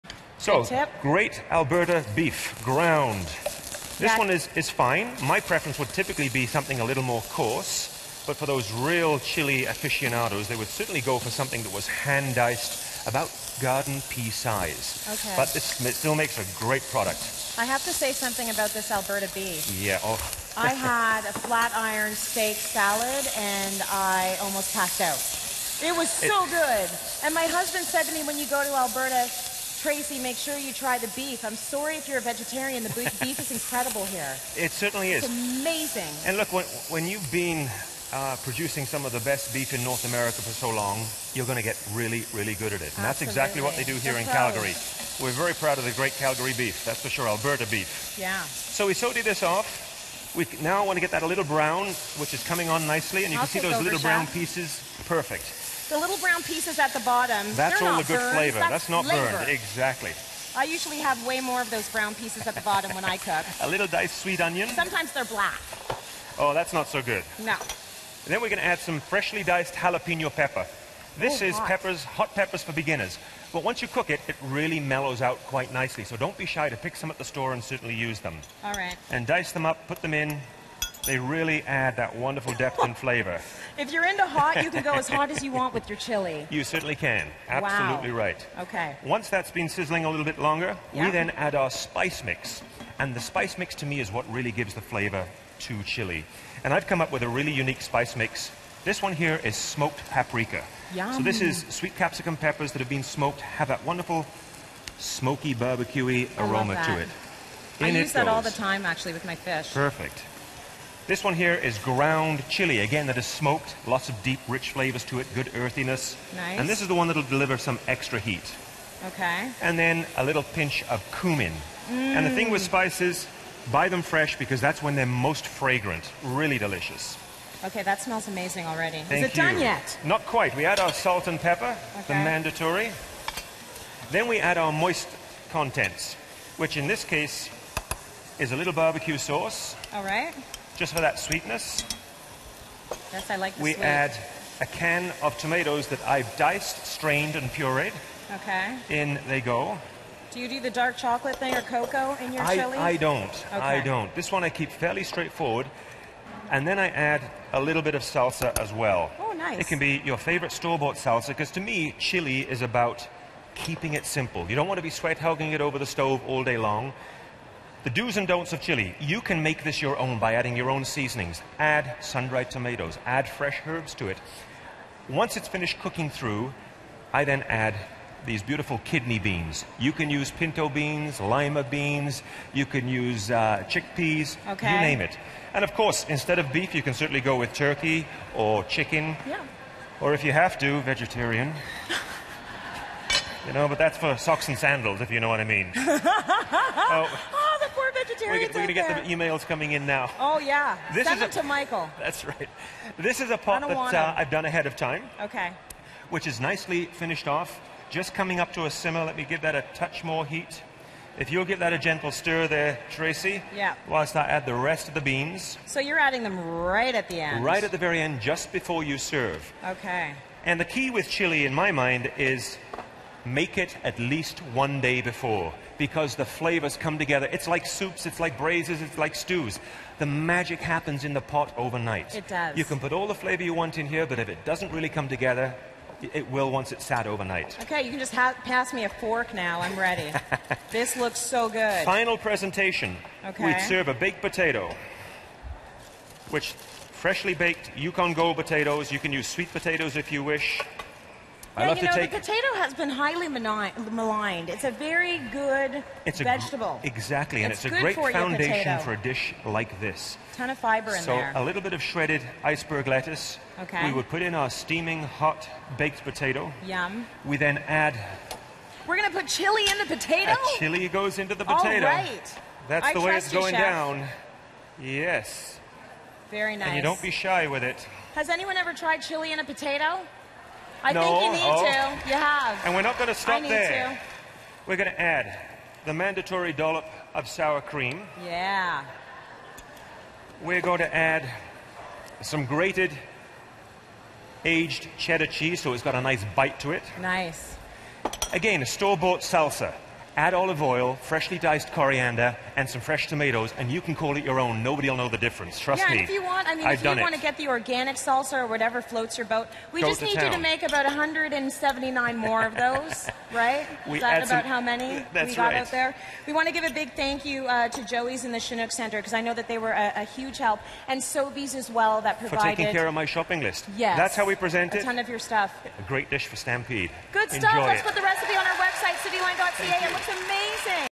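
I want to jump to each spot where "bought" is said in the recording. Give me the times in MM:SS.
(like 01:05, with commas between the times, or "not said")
02:40, 04:58.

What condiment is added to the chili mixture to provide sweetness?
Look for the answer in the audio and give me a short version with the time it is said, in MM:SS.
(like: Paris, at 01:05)
Barbecue sauce, at 02:18.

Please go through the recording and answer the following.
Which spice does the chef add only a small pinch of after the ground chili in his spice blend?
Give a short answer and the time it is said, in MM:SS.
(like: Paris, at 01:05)
Cumin, at 02:01.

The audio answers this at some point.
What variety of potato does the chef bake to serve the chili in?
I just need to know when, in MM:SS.
04:07.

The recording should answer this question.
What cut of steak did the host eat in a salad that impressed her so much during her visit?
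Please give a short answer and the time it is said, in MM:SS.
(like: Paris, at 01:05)
Flat iron steak, at 00:21.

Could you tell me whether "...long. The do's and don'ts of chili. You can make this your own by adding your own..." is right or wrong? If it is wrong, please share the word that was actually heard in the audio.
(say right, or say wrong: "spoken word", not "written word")
right.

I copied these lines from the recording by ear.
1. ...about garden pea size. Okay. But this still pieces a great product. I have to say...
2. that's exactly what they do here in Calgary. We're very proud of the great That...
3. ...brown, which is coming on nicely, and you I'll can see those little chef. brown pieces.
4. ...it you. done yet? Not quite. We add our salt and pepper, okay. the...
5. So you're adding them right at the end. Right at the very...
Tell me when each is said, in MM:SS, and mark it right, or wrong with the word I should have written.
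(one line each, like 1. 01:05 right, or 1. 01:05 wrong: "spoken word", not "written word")
1. 00:13 wrong: "makes", not "pieces"
2. 00:43 wrong: "Calgary", not "That"
3. 00:51 right
4. 02:09 right
5. 03:35 right.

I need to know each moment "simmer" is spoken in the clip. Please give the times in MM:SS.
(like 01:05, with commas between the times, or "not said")
03:28.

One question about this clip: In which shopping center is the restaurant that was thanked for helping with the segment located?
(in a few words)
Chinook Center.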